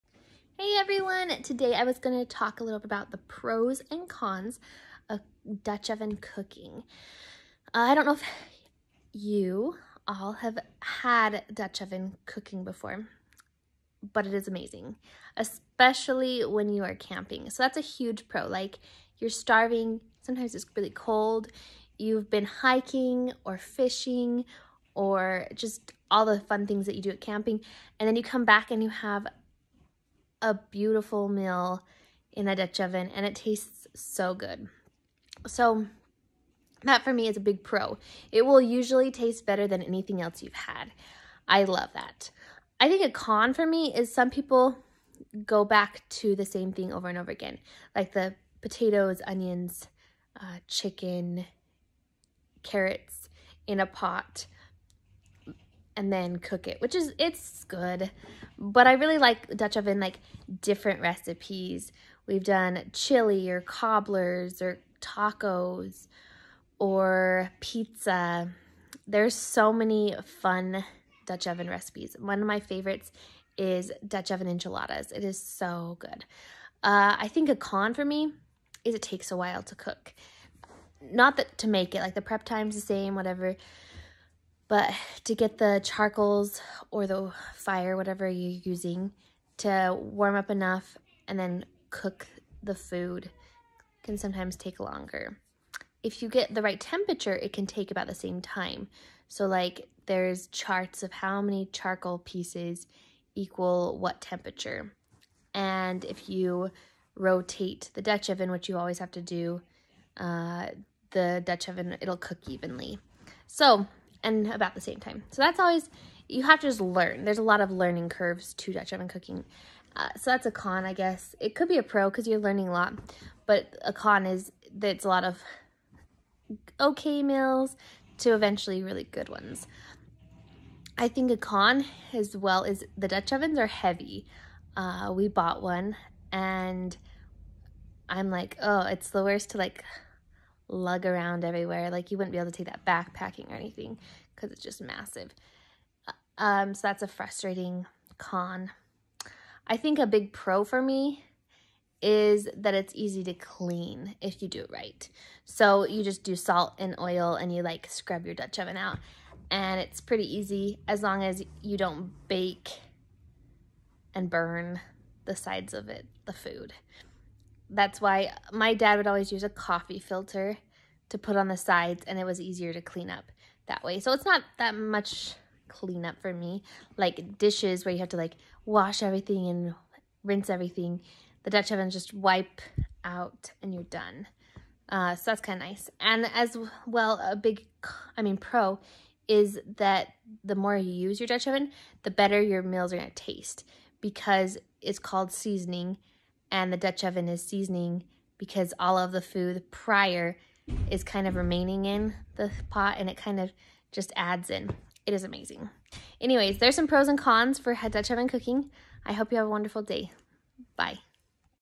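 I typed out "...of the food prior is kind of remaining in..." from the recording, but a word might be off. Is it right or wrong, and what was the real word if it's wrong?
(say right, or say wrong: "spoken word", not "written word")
right.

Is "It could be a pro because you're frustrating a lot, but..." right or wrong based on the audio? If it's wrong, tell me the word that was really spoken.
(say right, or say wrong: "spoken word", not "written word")
wrong: "learning", not "frustrating".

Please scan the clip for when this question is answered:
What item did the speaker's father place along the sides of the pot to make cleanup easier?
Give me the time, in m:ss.
2:49.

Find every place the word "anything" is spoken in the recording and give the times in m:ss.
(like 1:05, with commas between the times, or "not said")
0:39, 2:23.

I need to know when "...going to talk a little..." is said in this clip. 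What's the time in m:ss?
0:01.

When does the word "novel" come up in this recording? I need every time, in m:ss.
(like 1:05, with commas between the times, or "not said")
not said.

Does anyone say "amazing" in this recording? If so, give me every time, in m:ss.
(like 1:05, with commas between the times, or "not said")
0:14, 3:25.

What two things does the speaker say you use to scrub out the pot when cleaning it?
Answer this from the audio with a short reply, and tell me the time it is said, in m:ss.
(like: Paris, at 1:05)
salt and oil, at 2:36.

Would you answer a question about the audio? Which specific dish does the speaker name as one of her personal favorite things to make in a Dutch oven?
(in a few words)
Dutch oven enchiladas.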